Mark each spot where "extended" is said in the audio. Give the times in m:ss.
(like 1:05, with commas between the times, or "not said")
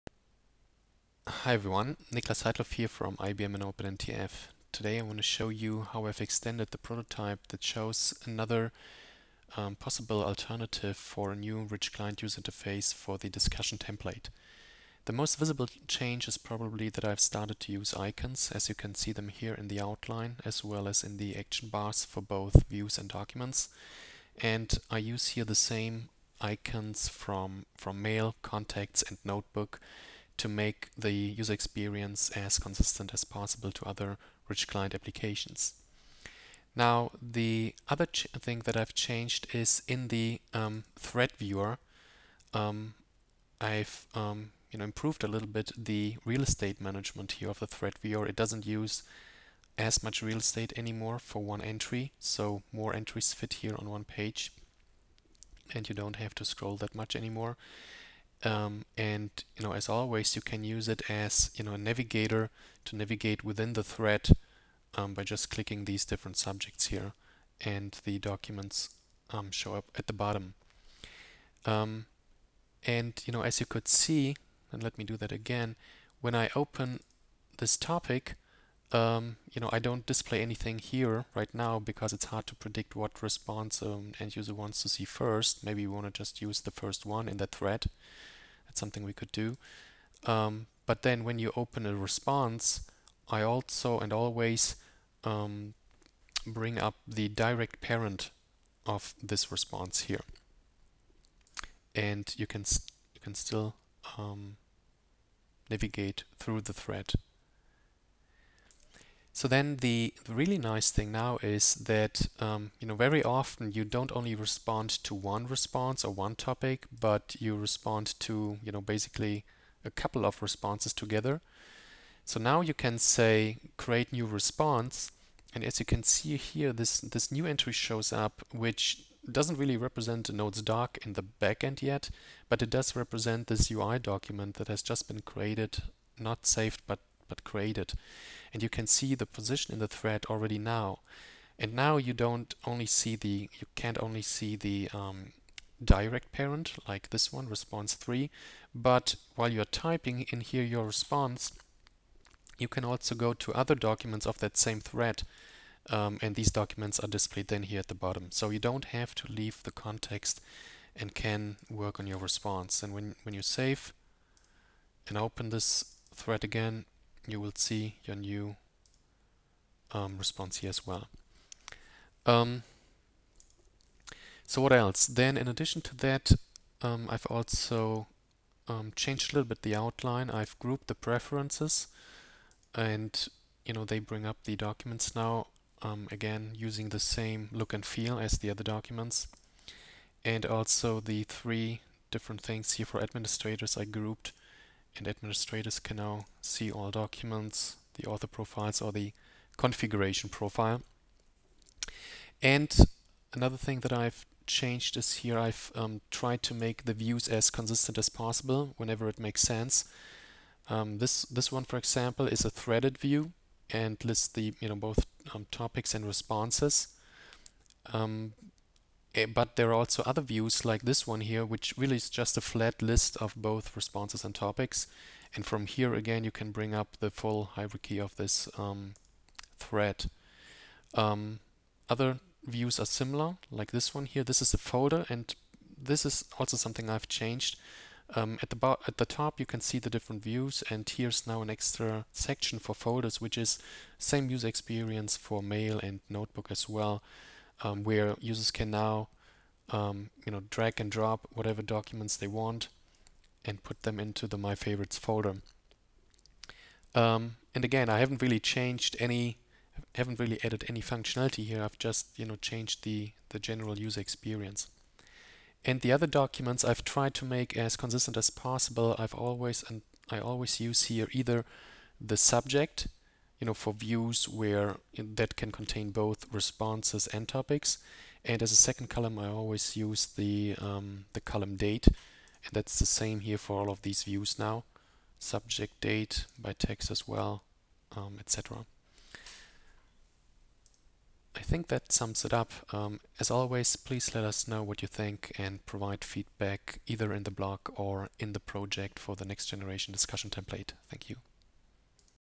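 0:06.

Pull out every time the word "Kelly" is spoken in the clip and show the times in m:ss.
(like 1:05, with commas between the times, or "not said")
not said.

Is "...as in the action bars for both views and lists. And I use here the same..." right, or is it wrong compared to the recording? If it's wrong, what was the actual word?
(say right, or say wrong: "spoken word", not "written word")
wrong: "documents", not "lists".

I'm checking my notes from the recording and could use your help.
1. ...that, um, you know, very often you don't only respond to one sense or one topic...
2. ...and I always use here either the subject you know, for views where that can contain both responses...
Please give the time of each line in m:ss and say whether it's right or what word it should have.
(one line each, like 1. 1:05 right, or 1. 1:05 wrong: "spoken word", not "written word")
1. 1:51 wrong: "response", not "sense"
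2. 4:29 right.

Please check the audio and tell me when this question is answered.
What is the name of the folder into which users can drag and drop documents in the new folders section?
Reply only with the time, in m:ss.
4:14.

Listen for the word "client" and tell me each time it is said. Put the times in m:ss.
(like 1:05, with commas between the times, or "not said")
0:11, 0:34.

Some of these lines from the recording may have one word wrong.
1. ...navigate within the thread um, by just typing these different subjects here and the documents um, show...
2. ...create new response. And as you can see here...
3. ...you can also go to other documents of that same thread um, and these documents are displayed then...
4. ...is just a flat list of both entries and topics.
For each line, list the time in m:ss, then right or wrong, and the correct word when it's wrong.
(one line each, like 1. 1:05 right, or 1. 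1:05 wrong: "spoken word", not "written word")
1. 1:02 wrong: "clicking", not "typing"
2. 2:03 right
3. 2:32 right
4. 3:41 wrong: "responses", not "entries".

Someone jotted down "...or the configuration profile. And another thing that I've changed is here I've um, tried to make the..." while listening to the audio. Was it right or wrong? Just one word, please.
right.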